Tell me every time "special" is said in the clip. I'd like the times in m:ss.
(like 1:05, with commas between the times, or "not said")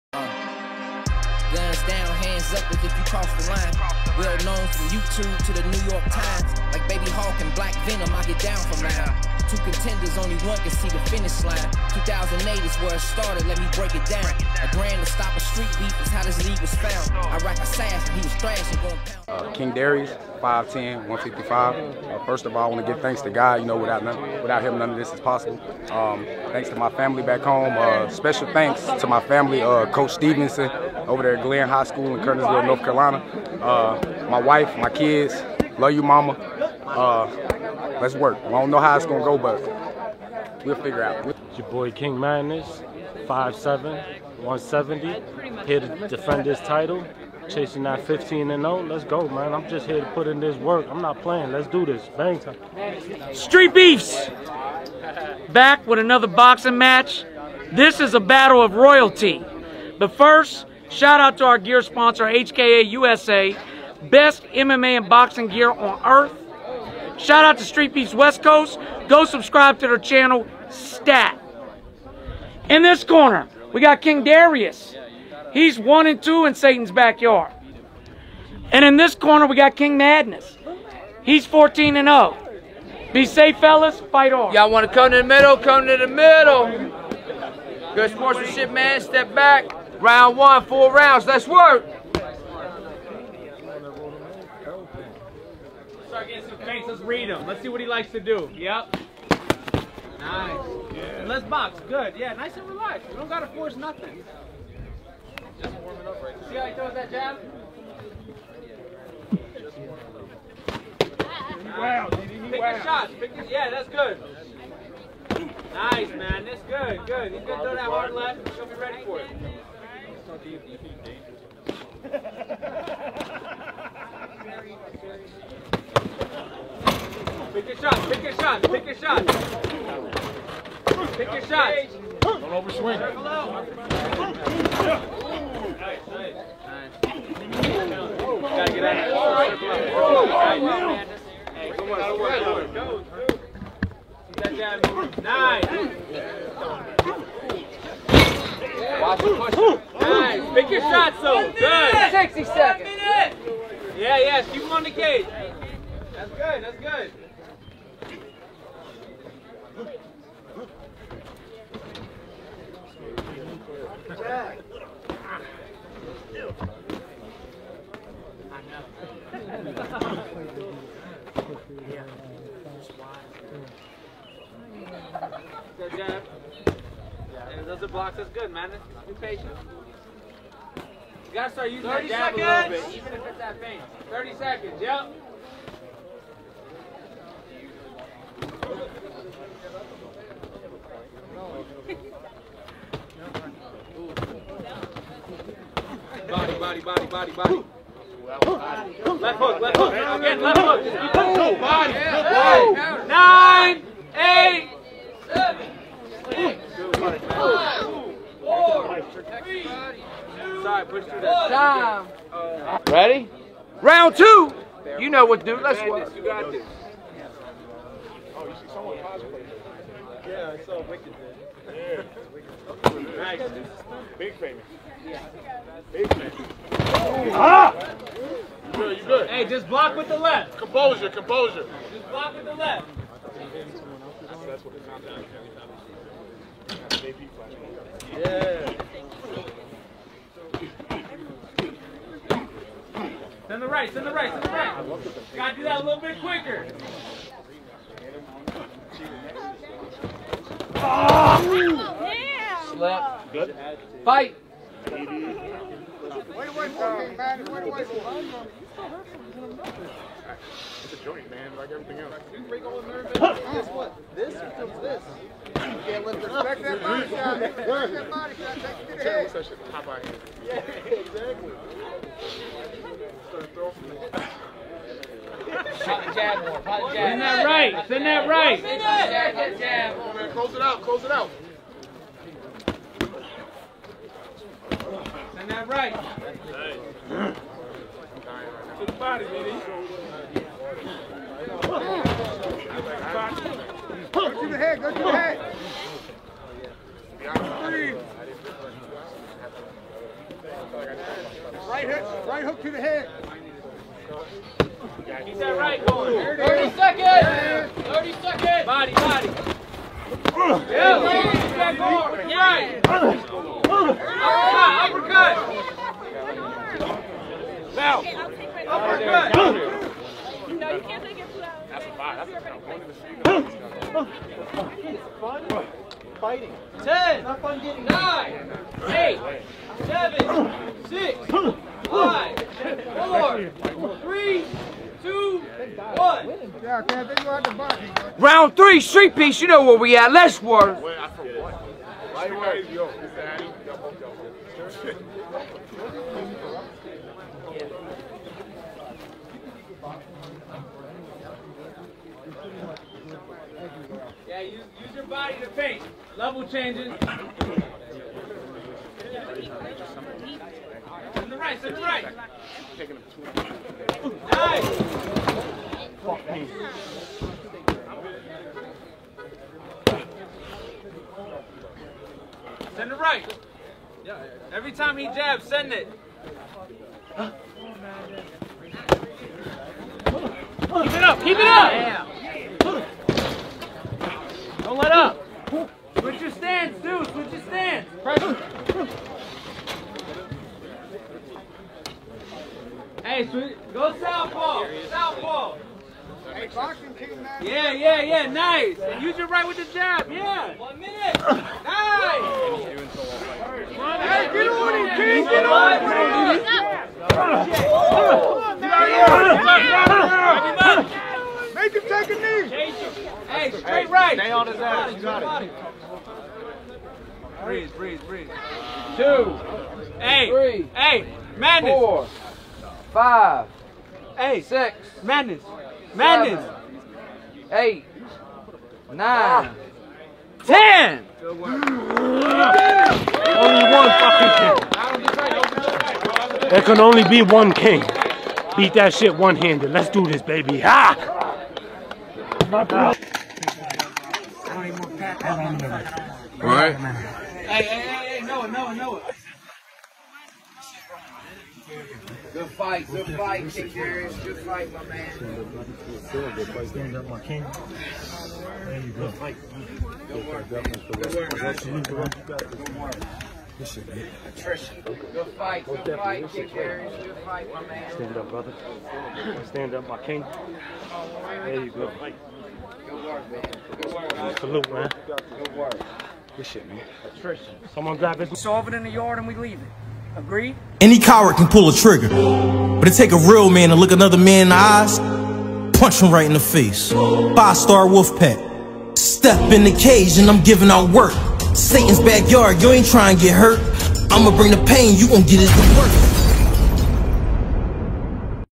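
0:28.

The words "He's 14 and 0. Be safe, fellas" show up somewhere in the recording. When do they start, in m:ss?
1:21.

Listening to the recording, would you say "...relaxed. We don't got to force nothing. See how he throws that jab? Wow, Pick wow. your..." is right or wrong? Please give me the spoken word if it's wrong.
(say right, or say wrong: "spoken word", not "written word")
right.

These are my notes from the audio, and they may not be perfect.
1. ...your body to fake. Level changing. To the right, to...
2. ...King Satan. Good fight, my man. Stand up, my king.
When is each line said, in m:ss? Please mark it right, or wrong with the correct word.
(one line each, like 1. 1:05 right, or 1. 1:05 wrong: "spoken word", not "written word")
1. 5:54 right
2. 7:33 wrong: "Darius", not "Satan".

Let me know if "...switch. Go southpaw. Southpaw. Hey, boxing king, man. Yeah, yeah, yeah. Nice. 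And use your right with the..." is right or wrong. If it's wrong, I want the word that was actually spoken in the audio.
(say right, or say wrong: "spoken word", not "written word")
right.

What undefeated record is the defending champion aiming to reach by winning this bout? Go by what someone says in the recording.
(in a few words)
15 and 0.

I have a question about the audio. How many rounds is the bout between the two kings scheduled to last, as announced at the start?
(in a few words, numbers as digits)
4.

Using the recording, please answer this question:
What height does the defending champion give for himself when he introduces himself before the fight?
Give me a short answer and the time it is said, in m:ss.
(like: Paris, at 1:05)
5'7", at 0:43.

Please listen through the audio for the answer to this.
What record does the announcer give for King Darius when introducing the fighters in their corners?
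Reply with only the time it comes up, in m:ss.
1:15.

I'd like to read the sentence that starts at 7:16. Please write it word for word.
There can only be one king.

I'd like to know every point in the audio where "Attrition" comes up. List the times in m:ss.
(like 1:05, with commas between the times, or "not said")
7:44, 7:57.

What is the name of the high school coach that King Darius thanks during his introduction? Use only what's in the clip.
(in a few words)
Coach Stevenson.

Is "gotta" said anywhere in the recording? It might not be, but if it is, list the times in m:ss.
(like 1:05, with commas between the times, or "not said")
3:01, 4:05.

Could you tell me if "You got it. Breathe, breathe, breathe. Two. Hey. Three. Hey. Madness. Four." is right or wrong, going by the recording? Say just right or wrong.
right.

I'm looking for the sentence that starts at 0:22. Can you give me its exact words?
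Uh, first of all, I want to give thanks to God.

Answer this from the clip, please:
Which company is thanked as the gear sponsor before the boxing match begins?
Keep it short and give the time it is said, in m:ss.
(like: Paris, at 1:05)
HKA USA, at 1:02.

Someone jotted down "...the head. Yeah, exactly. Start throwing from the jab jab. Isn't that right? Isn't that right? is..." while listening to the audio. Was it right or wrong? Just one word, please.
right.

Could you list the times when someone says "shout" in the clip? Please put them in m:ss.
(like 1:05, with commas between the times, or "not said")
1:00, 1:07.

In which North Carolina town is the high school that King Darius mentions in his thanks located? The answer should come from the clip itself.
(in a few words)
Kernersville.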